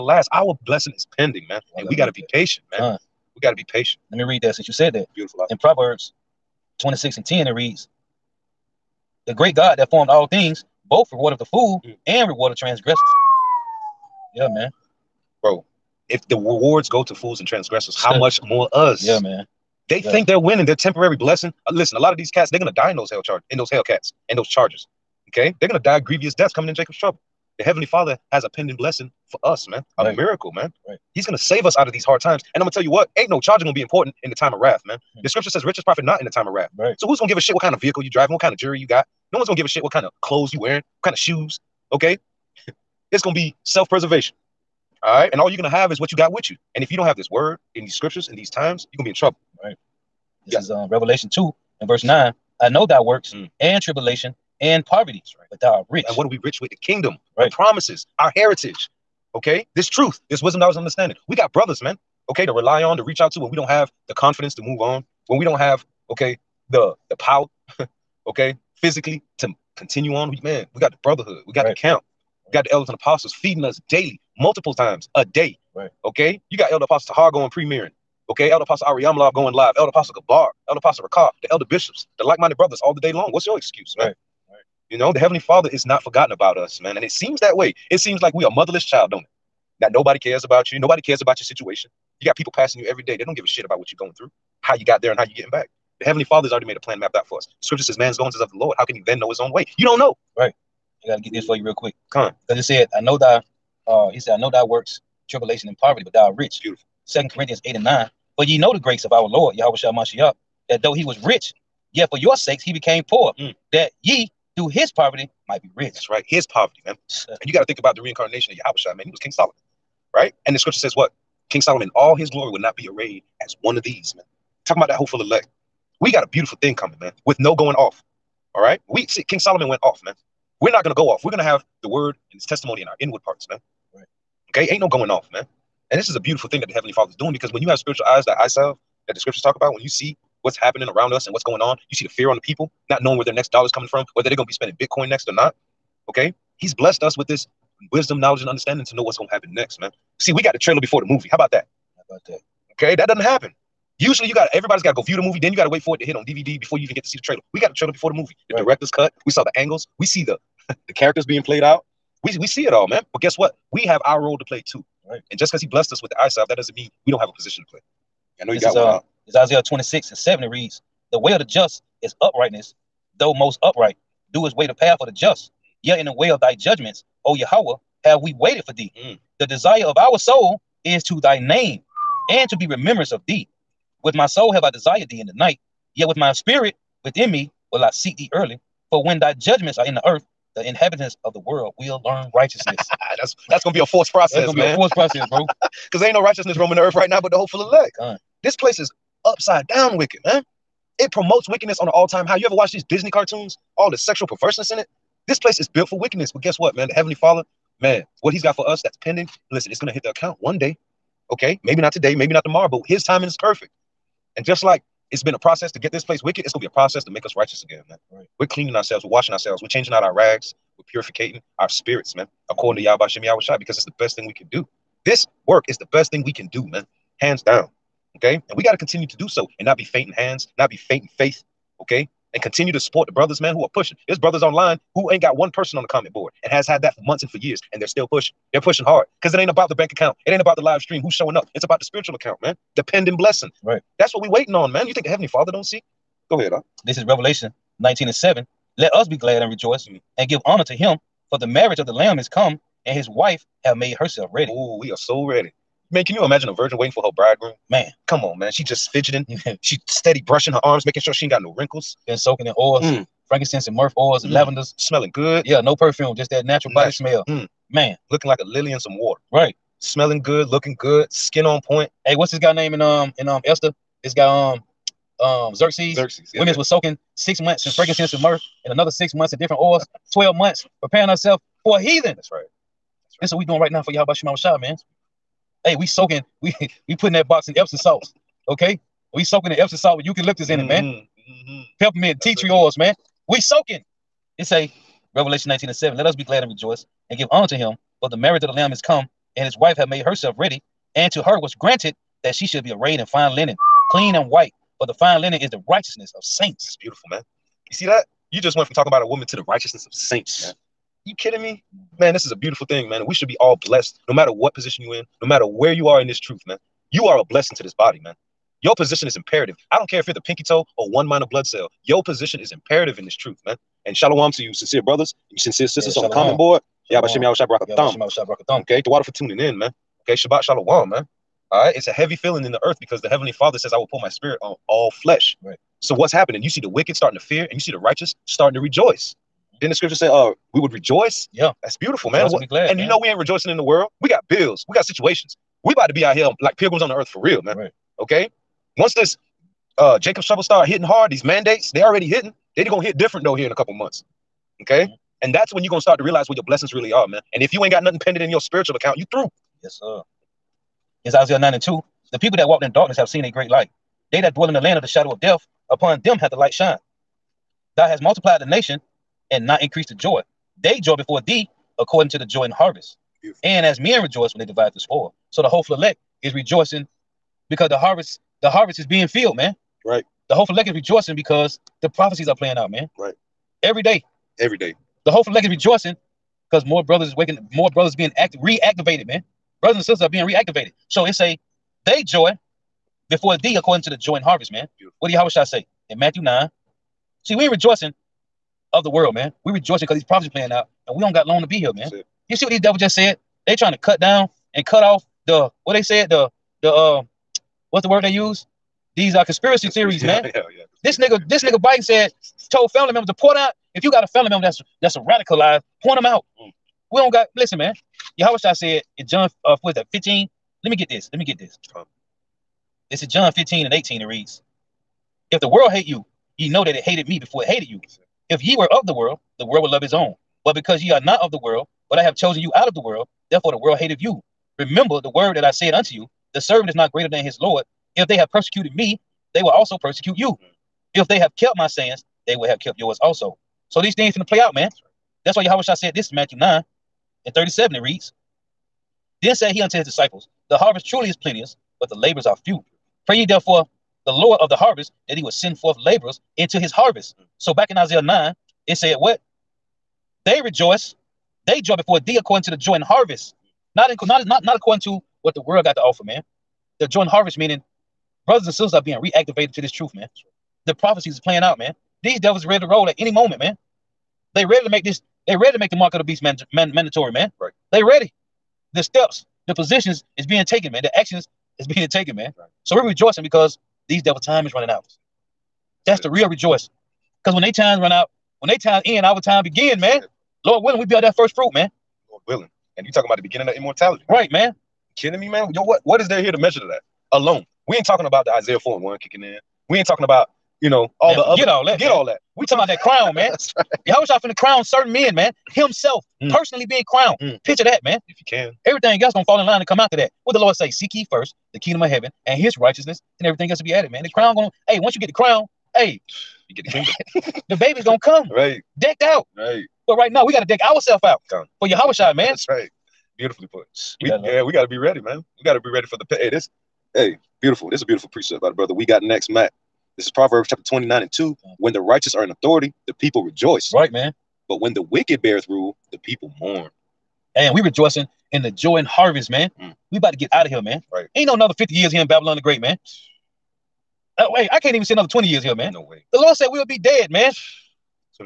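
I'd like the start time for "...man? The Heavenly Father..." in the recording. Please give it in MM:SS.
03:26.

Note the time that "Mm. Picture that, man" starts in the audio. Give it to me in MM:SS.
08:27.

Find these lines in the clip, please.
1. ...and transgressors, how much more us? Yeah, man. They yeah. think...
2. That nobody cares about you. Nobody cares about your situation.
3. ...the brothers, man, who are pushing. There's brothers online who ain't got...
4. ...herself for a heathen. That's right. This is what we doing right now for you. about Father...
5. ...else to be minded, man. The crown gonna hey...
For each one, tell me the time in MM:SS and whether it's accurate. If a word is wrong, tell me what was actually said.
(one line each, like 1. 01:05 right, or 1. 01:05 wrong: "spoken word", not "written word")
1. 00:17 right
2. 01:29 right
3. 03:53 right
4. 04:41 wrong: "Shema", not "Father"
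5. 08:33 wrong: "added", not "minded".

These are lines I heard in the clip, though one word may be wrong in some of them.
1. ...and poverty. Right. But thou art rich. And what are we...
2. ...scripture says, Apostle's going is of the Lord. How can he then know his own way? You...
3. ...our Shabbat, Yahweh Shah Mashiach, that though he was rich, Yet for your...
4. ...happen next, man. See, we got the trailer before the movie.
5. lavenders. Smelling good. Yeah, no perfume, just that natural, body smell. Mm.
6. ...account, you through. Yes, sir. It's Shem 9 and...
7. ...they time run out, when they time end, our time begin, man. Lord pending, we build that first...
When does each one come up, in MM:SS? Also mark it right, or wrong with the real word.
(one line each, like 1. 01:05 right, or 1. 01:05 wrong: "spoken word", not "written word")
1. 00:54 right
2. 01:37 wrong: "Man", not "Apostle"
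3. 01:49 wrong: "Lord", not "Shabbat"
4. 02:29 right
5. 04:24 right
6. 05:58 wrong: "Isaiah", not "Shem"
7. 08:07 wrong: "willing", not "pending".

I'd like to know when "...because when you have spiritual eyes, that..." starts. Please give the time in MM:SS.
02:17.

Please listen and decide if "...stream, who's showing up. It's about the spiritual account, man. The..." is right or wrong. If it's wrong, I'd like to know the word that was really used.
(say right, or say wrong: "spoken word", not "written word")
right.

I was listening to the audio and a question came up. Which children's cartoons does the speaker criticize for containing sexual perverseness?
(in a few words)
Disney.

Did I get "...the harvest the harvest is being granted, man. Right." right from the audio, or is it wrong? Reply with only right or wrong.
wrong.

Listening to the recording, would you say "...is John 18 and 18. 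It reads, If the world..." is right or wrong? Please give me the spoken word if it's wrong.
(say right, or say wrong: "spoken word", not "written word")
wrong: "15", not "18".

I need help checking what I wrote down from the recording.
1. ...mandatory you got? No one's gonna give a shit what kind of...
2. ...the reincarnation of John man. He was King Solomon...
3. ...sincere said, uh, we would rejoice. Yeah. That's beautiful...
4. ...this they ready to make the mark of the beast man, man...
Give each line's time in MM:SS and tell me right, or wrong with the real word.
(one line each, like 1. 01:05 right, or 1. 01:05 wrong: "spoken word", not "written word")
1. 00:38 wrong: "jewelry", not "mandatory"
2. 01:57 wrong: "Yahweh", not "John"
3. 05:39 wrong: "scripture", not "sincere"
4. 07:54 right.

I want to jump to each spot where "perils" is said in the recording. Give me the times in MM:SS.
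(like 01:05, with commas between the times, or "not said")
not said.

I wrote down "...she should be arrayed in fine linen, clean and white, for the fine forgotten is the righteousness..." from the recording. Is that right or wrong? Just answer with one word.
wrong.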